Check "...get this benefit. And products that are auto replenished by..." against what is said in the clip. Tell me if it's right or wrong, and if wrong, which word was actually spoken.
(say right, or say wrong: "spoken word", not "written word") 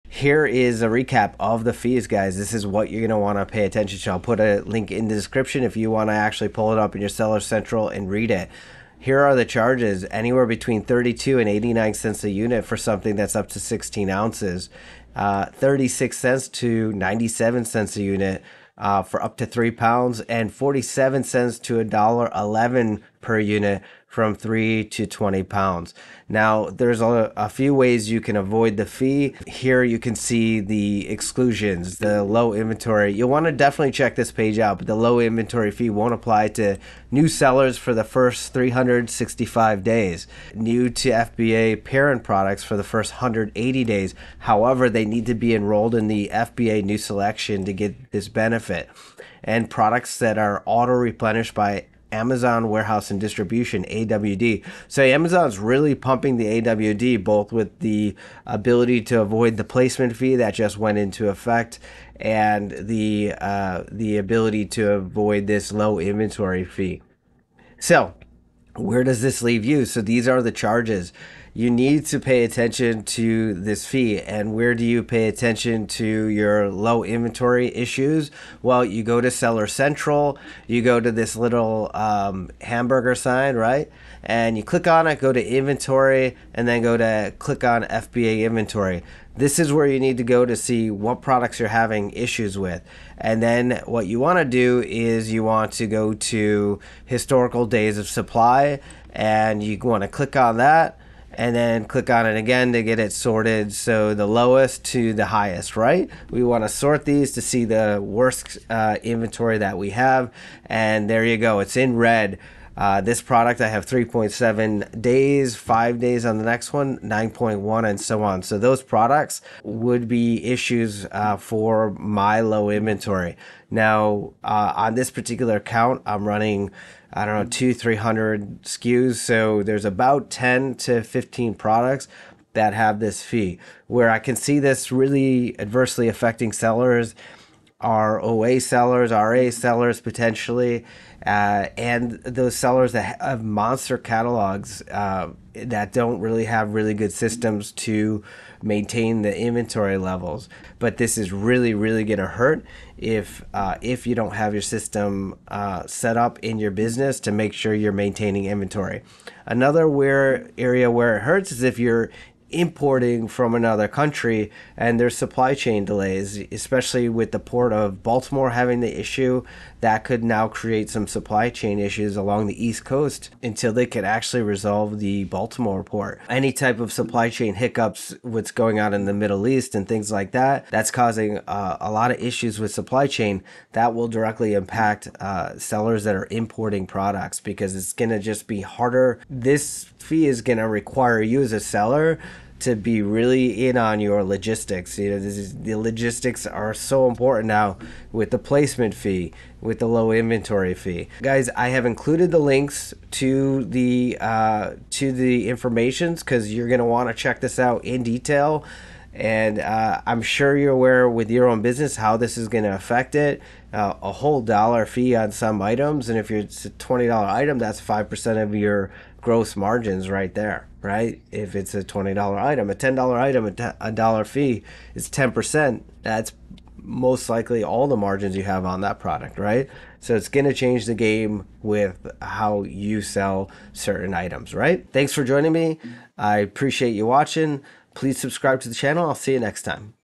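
right.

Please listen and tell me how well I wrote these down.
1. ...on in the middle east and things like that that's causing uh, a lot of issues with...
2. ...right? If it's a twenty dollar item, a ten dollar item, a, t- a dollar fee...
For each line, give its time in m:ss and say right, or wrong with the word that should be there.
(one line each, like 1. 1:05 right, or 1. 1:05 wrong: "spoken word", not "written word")
1. 2:58 right
2. 3:40 right.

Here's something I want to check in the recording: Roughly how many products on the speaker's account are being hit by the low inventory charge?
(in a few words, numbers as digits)
10 to 15.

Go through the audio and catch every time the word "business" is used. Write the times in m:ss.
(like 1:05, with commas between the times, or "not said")
2:36, 3:31.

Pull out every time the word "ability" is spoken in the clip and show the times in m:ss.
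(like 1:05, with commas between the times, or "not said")
0:58, 1:04.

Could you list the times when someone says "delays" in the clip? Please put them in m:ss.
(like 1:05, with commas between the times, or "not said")
2:45.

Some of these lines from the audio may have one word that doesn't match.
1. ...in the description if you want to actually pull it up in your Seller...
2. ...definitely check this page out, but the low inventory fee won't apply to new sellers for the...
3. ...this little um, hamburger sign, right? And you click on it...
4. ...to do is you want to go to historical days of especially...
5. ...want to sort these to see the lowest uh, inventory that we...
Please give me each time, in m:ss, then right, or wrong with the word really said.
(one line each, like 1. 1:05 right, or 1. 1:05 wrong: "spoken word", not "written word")
1. 0:04 right
2. 0:33 right
3. 1:21 right
4. 1:34 wrong: "supply", not "especially"
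5. 1:46 wrong: "worst", not "lowest".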